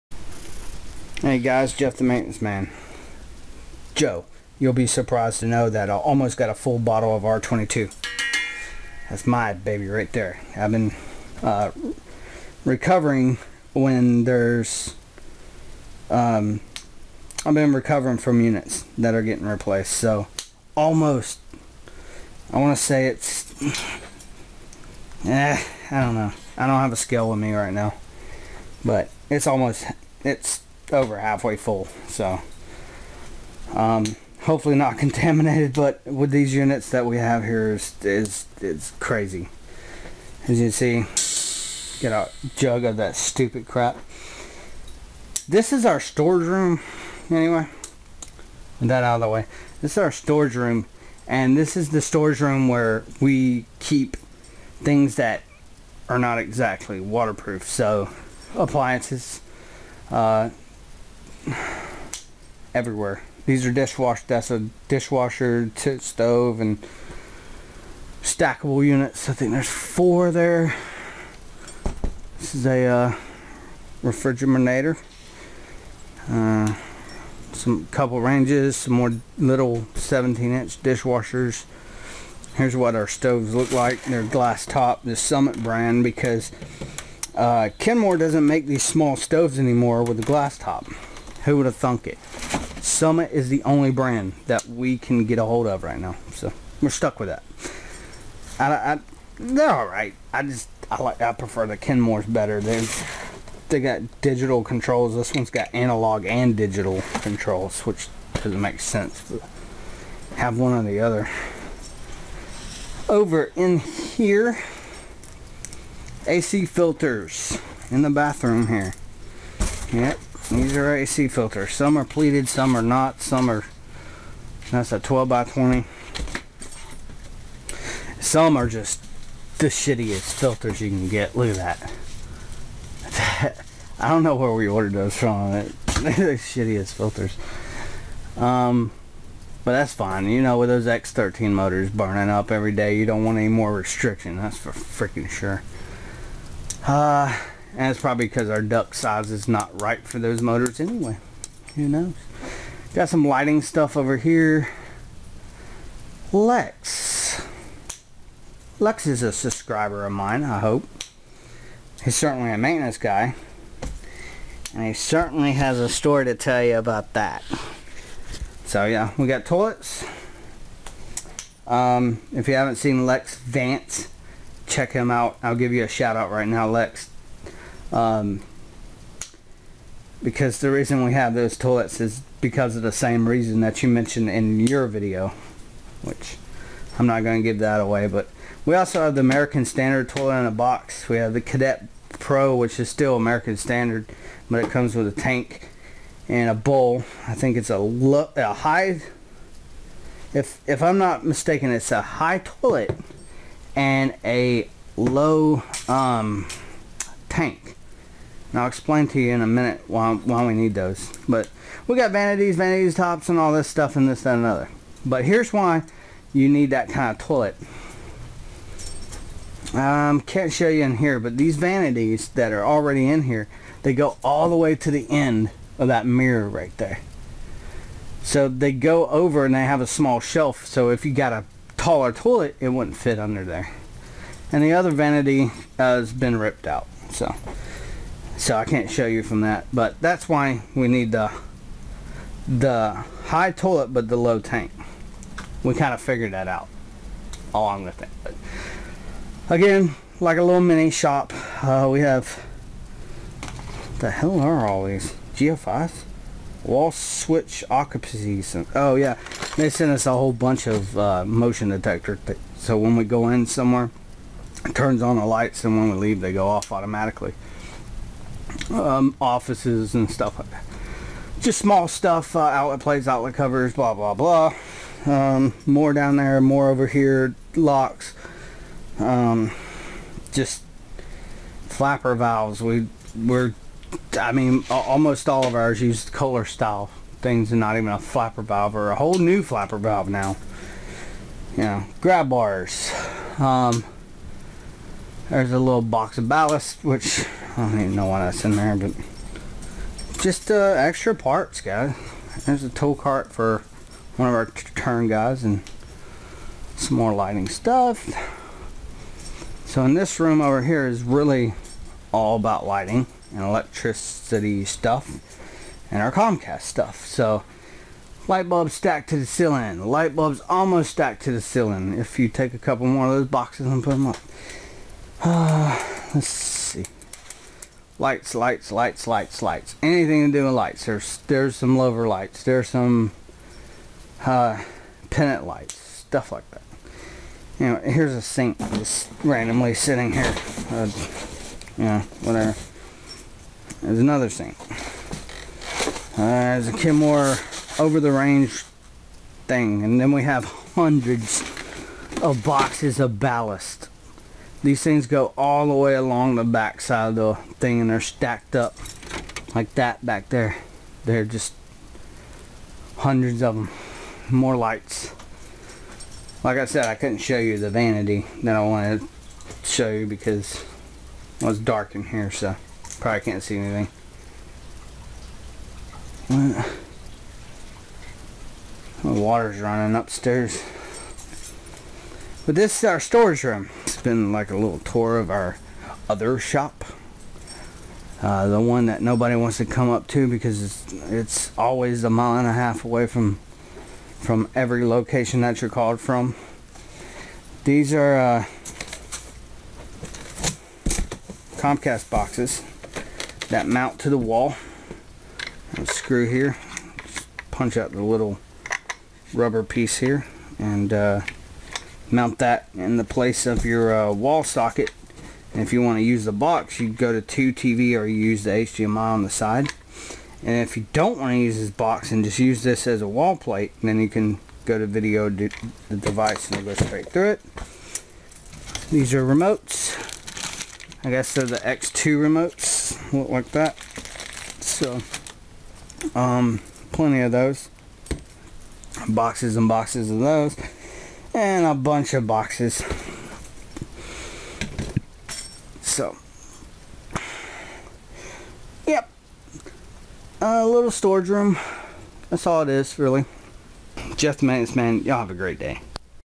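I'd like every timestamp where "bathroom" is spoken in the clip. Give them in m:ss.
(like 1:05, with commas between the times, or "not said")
1:58.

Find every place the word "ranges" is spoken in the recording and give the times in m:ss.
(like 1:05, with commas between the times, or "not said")
1:18, 5:48.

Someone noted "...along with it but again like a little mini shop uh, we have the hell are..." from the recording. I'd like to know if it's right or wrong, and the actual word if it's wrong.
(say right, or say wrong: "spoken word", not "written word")
right.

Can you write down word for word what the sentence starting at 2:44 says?
And he certainly has a story to tell you about that.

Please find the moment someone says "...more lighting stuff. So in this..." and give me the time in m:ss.
5:06.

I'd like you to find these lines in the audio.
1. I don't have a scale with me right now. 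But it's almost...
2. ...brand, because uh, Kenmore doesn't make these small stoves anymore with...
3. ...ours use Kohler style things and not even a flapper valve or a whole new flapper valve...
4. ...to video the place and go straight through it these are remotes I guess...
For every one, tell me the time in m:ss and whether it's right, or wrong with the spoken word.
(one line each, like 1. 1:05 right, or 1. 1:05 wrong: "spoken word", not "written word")
1. 0:26 right
2. 1:25 right
3. 4:45 right
4. 7:04 wrong: "device", not "place".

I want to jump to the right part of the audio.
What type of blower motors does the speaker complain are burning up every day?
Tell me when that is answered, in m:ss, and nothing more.
2:20.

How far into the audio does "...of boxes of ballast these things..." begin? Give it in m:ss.
5:52.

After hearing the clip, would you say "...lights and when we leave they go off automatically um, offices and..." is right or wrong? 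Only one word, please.
right.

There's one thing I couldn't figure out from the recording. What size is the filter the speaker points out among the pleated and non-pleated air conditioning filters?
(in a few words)
12 by 20.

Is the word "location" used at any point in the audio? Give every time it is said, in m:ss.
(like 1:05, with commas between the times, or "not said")
6:34.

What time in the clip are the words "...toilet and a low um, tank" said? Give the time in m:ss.
3:22.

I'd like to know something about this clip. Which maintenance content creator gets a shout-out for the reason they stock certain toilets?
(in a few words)
Lex Vance.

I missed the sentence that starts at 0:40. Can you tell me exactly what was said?
As you see, get a jug of that stupid crap.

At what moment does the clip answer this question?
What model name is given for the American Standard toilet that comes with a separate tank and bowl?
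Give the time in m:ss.
3:11.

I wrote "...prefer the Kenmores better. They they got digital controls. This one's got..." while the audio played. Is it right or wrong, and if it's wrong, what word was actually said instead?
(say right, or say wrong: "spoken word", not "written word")
right.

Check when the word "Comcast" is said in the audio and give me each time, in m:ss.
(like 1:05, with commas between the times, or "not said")
5:16, 6:41.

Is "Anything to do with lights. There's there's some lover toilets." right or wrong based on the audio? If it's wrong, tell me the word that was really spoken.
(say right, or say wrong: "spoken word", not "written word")
wrong: "lights", not "toilets".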